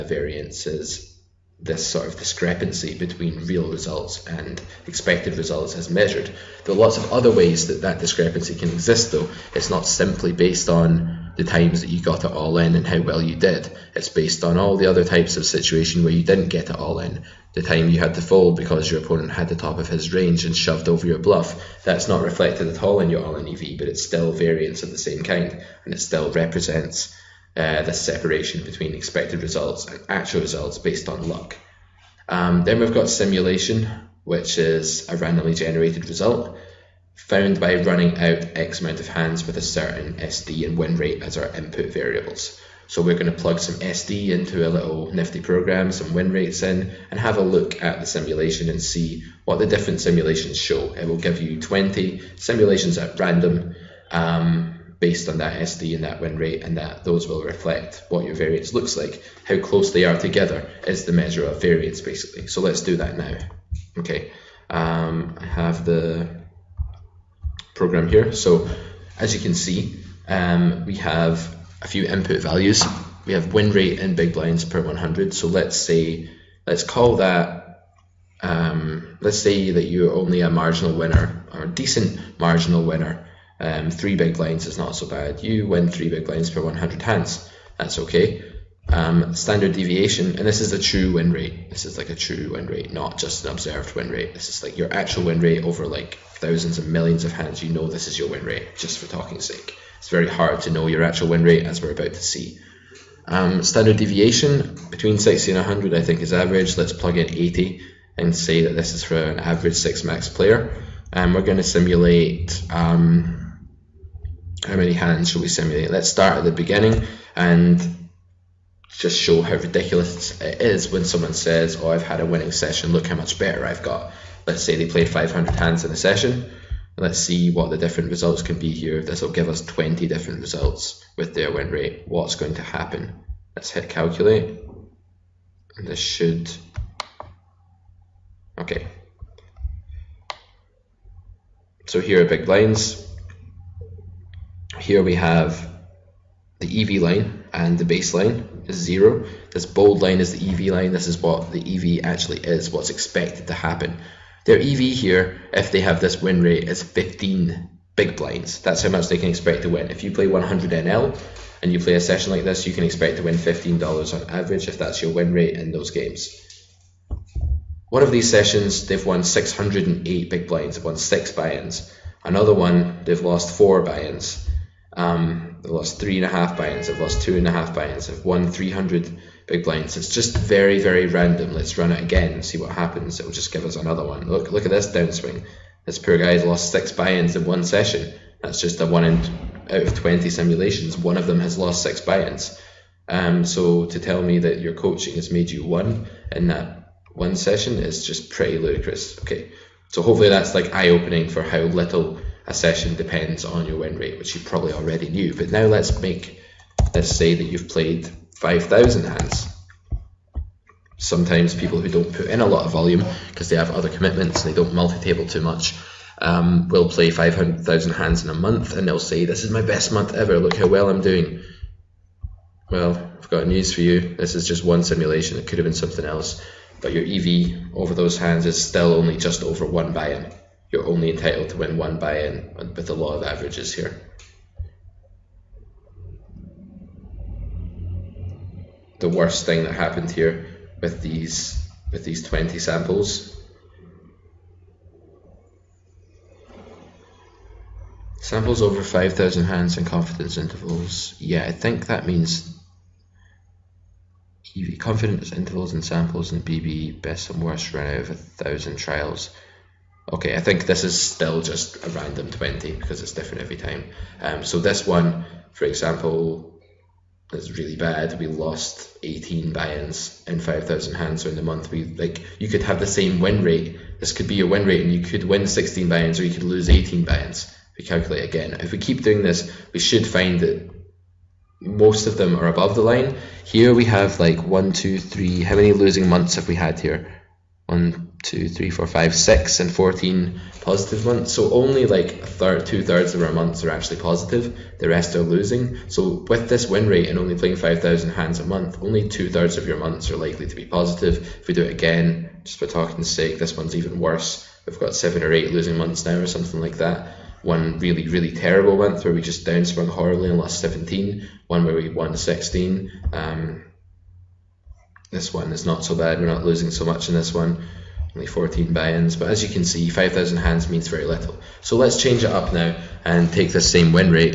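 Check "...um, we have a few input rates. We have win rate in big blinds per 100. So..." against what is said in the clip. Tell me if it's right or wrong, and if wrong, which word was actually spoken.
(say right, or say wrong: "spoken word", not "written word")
wrong: "values", not "rates".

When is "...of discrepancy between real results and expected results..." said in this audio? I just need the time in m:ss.
0:02.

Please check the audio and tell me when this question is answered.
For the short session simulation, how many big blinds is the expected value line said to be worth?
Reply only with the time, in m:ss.
2:36.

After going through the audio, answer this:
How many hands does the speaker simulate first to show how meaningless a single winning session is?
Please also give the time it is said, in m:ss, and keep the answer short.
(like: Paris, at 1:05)
500, at 2:05.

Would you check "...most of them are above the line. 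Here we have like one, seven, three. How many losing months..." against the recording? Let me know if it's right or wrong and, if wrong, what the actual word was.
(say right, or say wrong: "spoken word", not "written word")
wrong: "two", not "seven".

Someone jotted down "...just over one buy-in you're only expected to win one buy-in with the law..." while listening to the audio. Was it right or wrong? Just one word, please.
wrong.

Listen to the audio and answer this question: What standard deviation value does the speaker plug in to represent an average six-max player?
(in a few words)
80.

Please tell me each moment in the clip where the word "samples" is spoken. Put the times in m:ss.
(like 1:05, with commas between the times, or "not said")
4:02, 4:08, 4:15.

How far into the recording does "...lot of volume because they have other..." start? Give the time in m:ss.
3:32.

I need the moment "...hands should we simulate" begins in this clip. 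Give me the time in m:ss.
1:54.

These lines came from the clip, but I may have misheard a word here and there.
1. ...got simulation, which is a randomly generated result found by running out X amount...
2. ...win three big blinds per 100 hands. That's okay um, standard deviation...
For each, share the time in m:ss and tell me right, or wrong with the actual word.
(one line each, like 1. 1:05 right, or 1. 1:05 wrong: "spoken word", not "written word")
1. 0:32 right
2. 1:25 right.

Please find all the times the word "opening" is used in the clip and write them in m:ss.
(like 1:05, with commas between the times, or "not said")
3:20.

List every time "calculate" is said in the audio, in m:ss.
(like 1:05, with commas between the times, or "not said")
2:13, 4:37.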